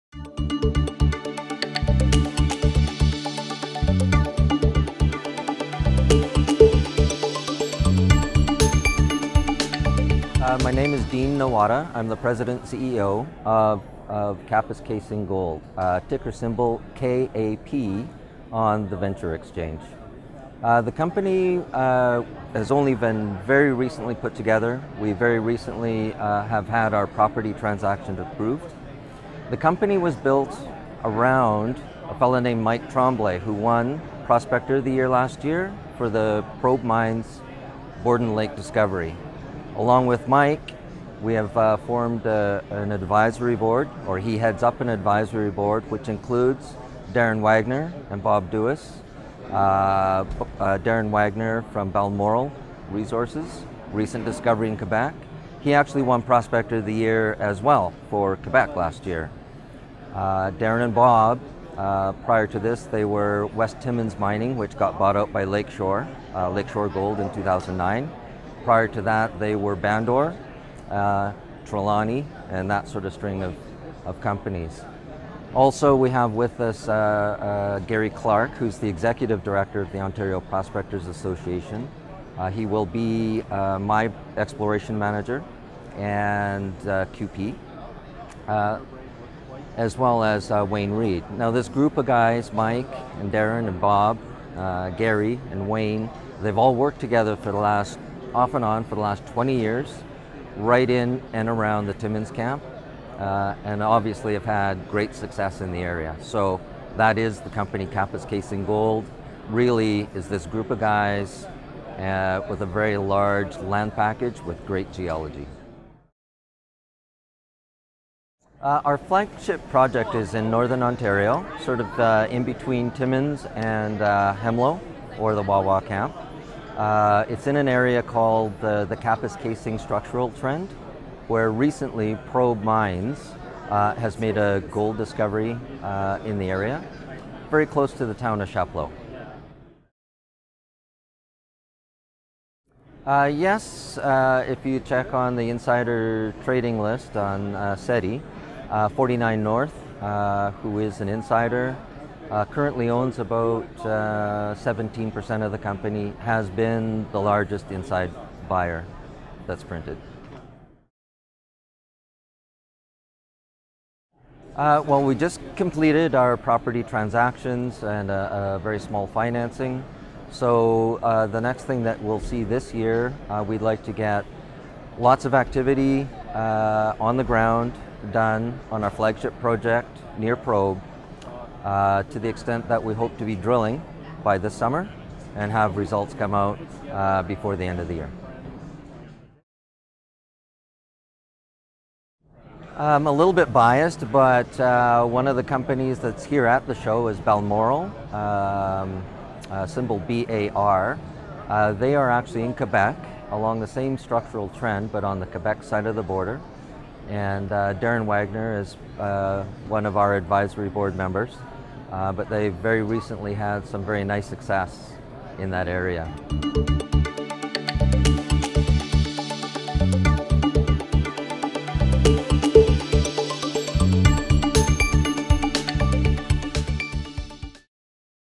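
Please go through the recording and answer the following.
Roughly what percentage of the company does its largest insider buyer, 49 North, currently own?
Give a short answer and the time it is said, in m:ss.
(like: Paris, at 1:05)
17%, at 2:33.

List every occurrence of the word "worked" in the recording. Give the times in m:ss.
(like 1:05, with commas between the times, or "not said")
1:36.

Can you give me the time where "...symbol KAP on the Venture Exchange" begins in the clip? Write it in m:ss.
0:16.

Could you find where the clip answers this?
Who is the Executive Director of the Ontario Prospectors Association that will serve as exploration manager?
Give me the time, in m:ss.
1:17.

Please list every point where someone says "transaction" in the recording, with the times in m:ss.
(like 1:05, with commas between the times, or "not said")
0:27, 2:46.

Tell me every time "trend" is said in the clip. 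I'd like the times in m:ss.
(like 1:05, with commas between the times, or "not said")
2:10, 3:24.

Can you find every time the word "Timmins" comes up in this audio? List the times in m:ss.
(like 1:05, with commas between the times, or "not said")
1:03, 1:41, 2:02.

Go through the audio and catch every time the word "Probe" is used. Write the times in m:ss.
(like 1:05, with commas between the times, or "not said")
0:36, 2:12, 3:00.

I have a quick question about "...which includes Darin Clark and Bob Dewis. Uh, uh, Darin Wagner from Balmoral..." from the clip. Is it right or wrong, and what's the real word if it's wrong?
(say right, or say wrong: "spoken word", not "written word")
wrong: "Wagner", not "Clark".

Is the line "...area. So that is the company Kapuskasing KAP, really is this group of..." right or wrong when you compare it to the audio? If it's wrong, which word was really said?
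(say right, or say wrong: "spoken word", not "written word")
wrong: "Gold", not "KAP".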